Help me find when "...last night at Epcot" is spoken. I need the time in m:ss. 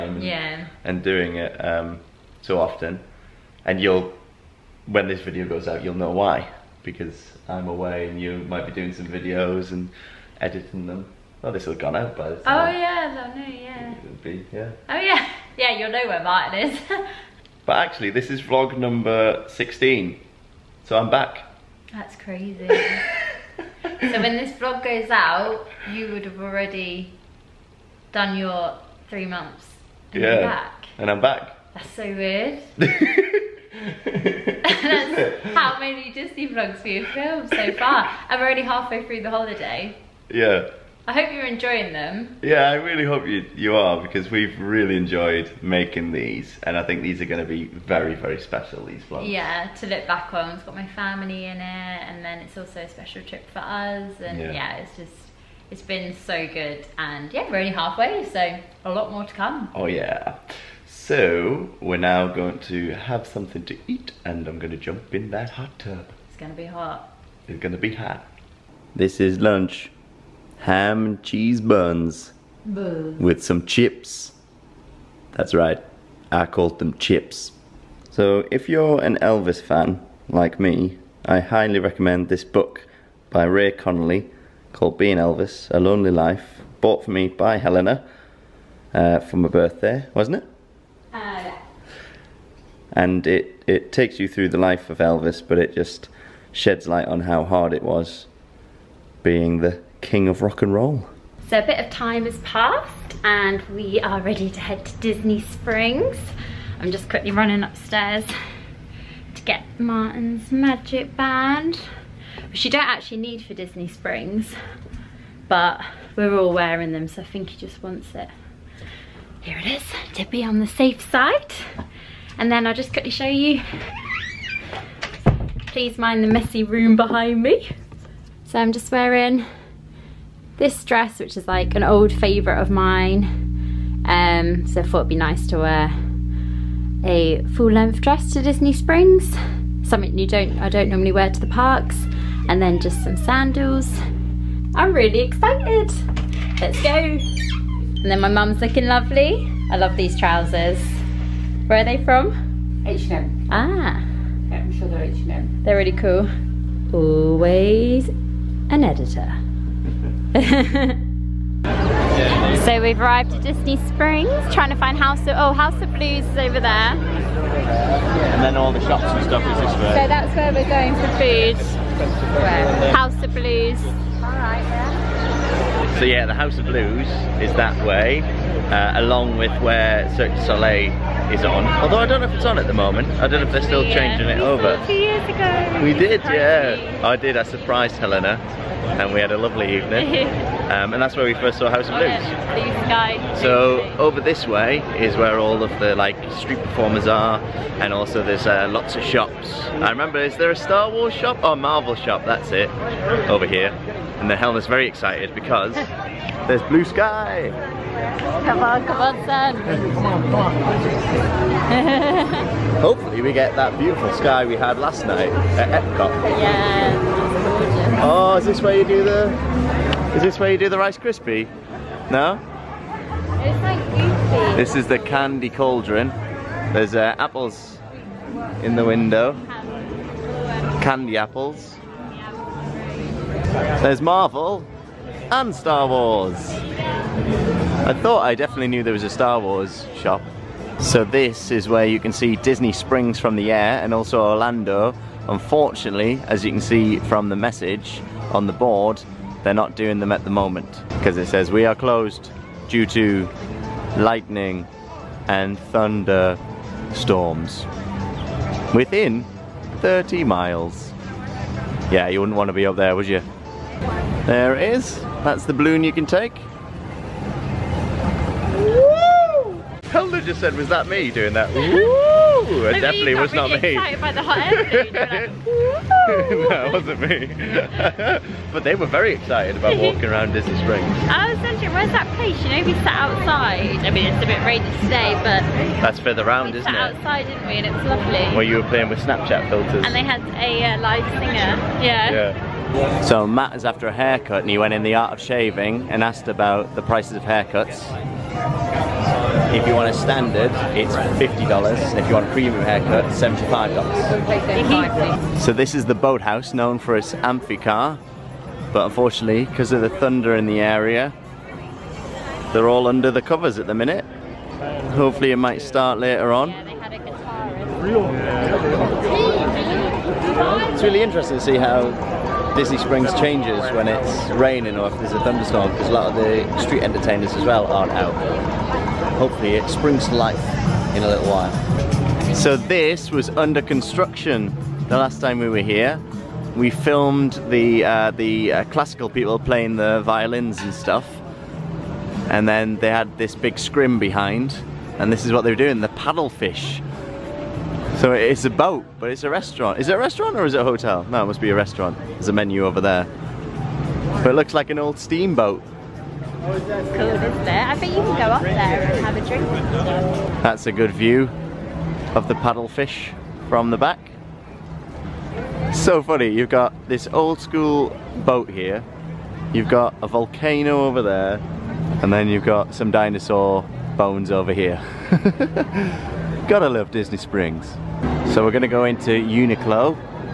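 3:34.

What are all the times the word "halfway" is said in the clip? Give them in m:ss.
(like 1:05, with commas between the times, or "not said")
0:38, 0:57.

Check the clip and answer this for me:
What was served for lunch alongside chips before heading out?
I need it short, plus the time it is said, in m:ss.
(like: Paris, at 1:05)
Ham and cheese buns, at 1:10.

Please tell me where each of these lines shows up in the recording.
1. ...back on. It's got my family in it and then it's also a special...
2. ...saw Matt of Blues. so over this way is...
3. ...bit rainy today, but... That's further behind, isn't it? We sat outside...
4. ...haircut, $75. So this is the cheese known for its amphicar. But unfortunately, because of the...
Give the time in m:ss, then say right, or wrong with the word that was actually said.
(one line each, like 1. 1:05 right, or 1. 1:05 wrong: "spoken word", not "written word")
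1. 0:50 right
2. 3:11 wrong: "House", not "Matt"
3. 4:44 wrong: "round", not "behind"
4. 5:02 wrong: "boathouse", not "cheese".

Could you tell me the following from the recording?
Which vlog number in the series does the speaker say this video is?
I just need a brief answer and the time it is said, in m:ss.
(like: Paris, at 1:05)
16, at 0:19.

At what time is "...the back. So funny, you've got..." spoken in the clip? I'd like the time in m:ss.
6:03.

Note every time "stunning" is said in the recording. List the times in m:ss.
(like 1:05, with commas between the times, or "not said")
not said.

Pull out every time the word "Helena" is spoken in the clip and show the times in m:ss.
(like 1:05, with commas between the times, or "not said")
1:27, 3:07, 3:24.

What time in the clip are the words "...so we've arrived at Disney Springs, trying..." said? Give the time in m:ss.
2:42.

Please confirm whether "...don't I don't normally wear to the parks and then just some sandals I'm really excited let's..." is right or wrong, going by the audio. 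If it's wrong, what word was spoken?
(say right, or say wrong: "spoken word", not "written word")
right.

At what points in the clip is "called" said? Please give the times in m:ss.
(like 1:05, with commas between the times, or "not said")
1:16, 1:24.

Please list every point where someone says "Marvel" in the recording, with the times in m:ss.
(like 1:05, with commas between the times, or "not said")
3:21, 3:54.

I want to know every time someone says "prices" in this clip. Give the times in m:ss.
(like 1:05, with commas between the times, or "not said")
4:56.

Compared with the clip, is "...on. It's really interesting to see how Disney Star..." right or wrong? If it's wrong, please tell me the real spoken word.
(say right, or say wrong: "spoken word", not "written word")
wrong: "Springs", not "Star".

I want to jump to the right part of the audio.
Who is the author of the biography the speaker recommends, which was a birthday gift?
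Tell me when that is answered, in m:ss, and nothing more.
1:23.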